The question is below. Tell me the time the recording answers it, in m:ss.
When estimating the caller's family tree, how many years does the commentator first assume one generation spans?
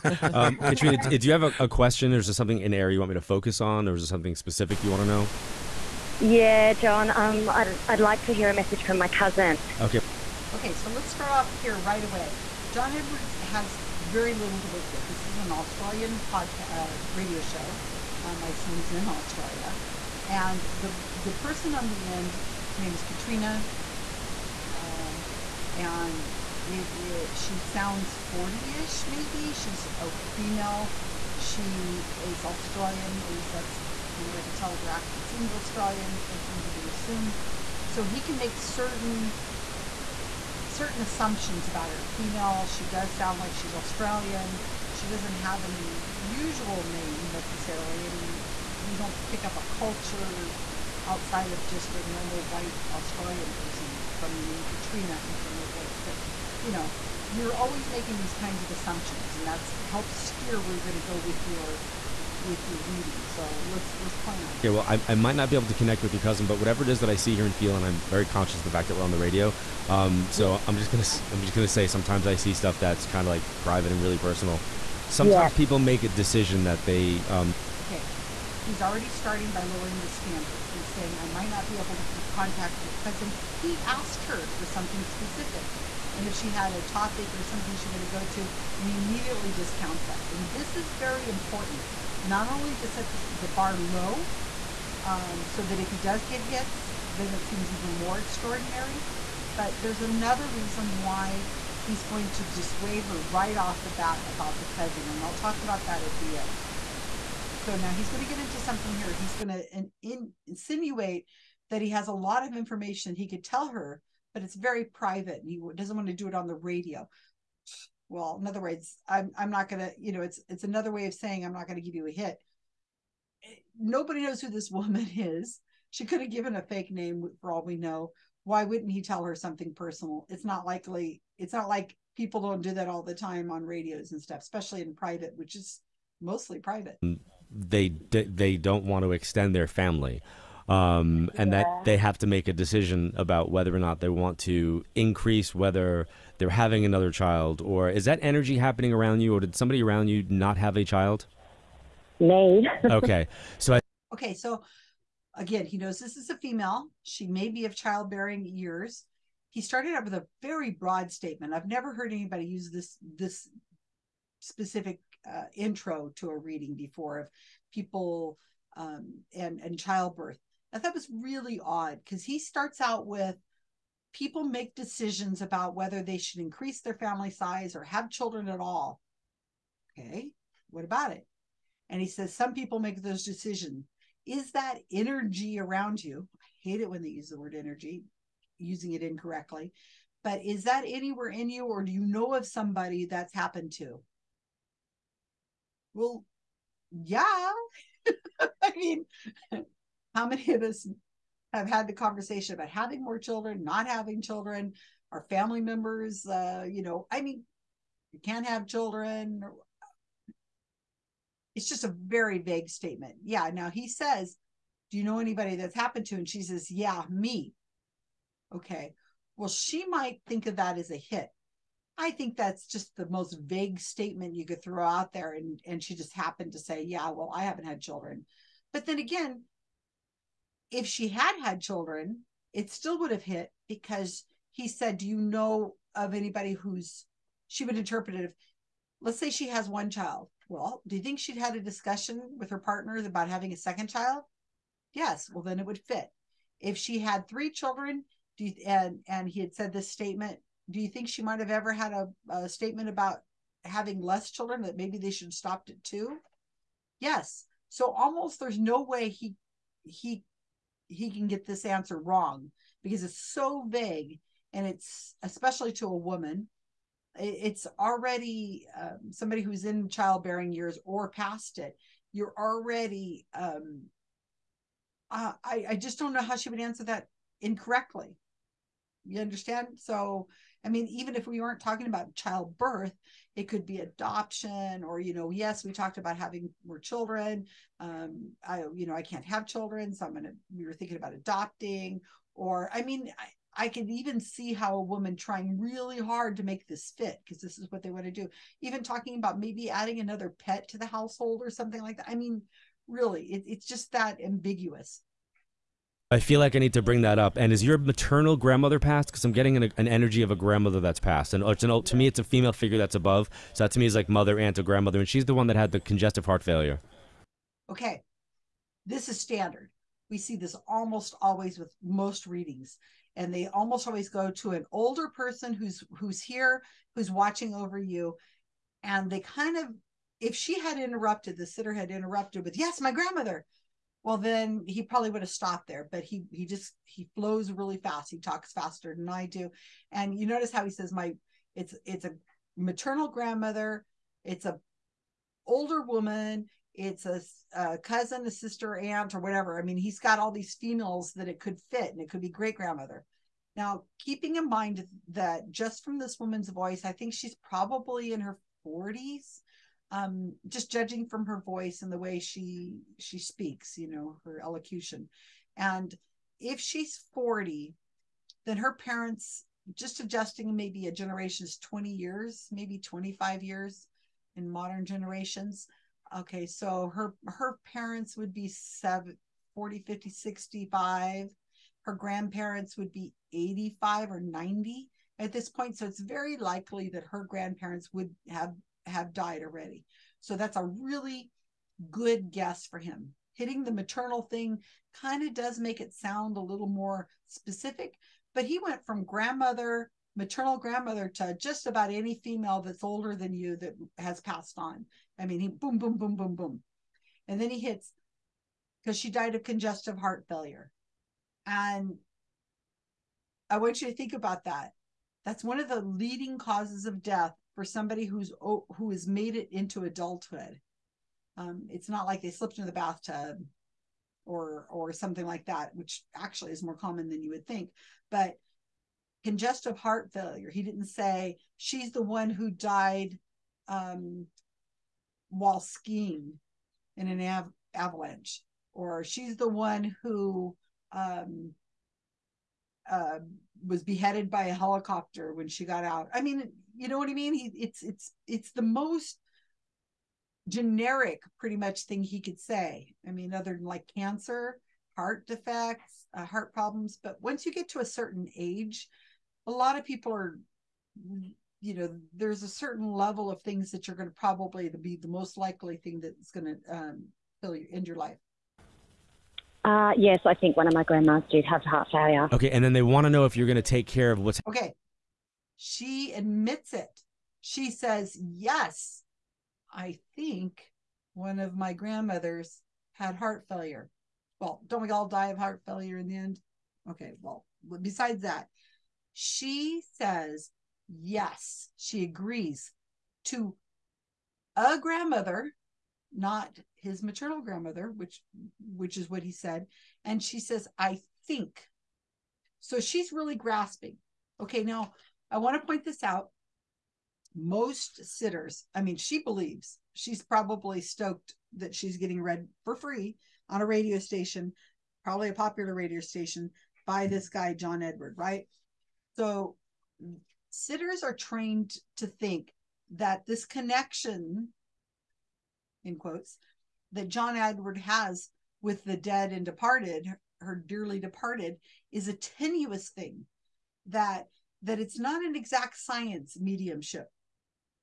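6:11.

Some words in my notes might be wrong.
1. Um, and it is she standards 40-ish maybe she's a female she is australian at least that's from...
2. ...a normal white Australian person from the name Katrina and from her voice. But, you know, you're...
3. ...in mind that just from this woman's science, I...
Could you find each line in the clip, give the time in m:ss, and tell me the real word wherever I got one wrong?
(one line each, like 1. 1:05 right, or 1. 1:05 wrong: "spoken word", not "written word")
1. 0:24 wrong: "sounds", not "standards"
2. 0:51 right
3. 5:54 wrong: "voice", not "science".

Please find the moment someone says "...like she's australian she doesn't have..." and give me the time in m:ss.
0:43.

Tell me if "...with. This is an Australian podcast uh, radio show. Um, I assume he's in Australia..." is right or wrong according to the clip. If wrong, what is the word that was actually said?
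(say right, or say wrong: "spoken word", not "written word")
right.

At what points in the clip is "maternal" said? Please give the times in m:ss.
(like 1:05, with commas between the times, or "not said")
5:07, 5:42, 6:33, 6:40, 8:17.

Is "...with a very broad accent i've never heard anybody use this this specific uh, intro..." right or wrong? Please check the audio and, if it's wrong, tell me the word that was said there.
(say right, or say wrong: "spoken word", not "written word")
wrong: "statement", not "accent".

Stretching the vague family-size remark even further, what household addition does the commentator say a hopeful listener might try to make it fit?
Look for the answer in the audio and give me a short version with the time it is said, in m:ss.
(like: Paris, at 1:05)
another pet, at 4:59.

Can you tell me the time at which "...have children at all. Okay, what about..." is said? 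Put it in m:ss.
2:57.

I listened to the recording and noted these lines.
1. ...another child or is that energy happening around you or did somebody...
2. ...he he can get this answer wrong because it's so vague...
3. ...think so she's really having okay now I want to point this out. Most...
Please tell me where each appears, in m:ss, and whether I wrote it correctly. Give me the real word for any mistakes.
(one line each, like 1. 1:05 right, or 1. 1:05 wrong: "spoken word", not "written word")
1. 2:26 right
2. 4:19 right
3. 8:21 wrong: "grasping", not "having".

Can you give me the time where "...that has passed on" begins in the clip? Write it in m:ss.
6:43.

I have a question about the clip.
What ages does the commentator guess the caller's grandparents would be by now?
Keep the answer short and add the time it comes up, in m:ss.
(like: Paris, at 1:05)
85 or 90, at 6:23.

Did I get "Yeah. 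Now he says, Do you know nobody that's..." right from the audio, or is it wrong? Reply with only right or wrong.
wrong.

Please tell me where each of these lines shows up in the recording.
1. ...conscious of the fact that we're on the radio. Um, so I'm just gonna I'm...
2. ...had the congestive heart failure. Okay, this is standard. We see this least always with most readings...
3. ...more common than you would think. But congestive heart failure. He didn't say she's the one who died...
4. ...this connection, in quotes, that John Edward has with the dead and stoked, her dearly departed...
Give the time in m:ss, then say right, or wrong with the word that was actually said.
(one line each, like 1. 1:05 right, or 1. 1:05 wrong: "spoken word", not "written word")
1. 1:08 right
2. 5:15 wrong: "almost", not "least"
3. 7:06 right
4. 8:43 wrong: "departed", not "stoked".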